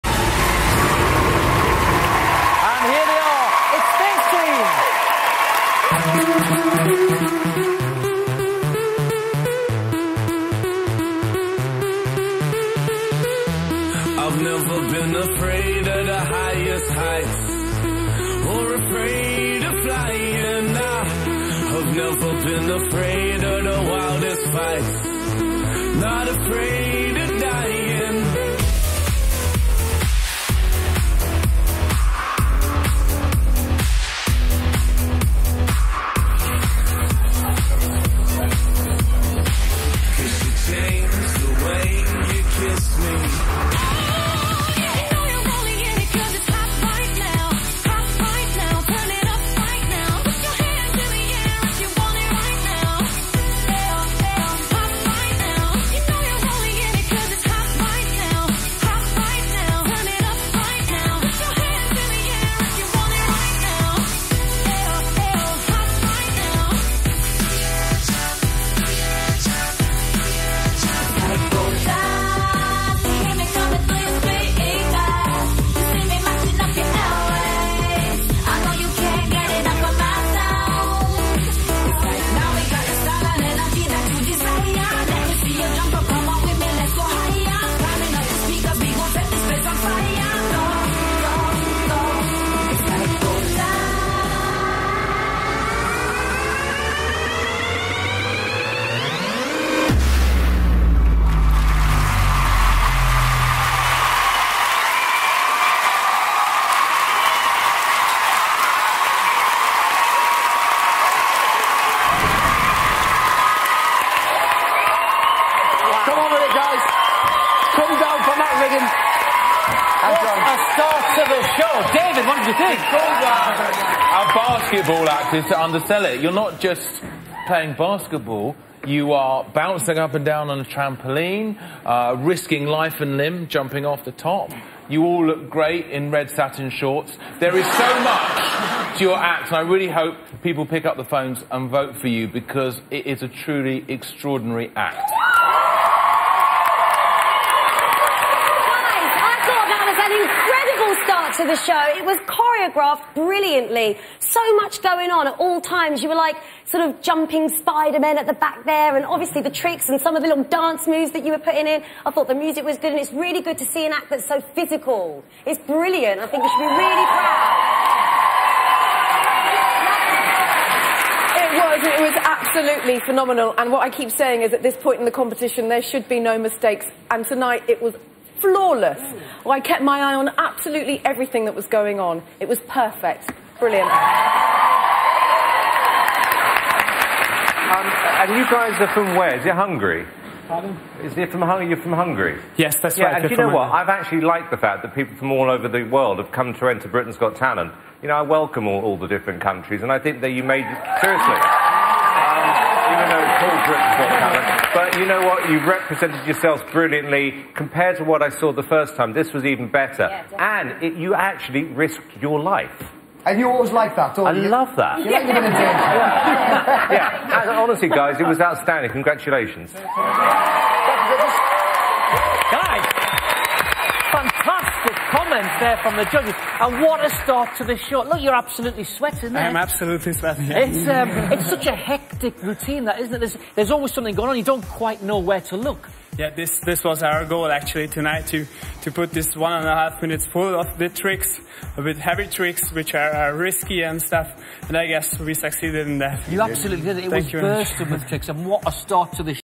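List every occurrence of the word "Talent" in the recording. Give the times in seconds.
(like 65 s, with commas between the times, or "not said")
197 s, 204 s.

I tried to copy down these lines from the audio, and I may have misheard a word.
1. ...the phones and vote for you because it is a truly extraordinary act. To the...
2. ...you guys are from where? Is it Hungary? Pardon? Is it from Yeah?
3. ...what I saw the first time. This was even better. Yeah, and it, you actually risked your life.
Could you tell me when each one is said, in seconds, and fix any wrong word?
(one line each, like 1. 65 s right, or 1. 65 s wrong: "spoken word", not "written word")
1. 140 s right
2. 188 s wrong: "Hungary", not "Yeah"
3. 208 s right.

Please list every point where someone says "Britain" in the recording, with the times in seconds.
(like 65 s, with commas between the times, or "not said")
196 s, 203 s.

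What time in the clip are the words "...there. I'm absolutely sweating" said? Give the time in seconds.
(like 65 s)
229 s.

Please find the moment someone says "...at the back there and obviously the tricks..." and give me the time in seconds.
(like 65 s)
158 s.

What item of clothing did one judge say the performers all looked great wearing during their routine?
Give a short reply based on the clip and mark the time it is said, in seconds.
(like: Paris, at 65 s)
red satin shorts, at 136 s.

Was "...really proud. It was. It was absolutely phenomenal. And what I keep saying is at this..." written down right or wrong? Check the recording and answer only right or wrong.
right.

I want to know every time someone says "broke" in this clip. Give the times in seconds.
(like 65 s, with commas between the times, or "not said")
not said.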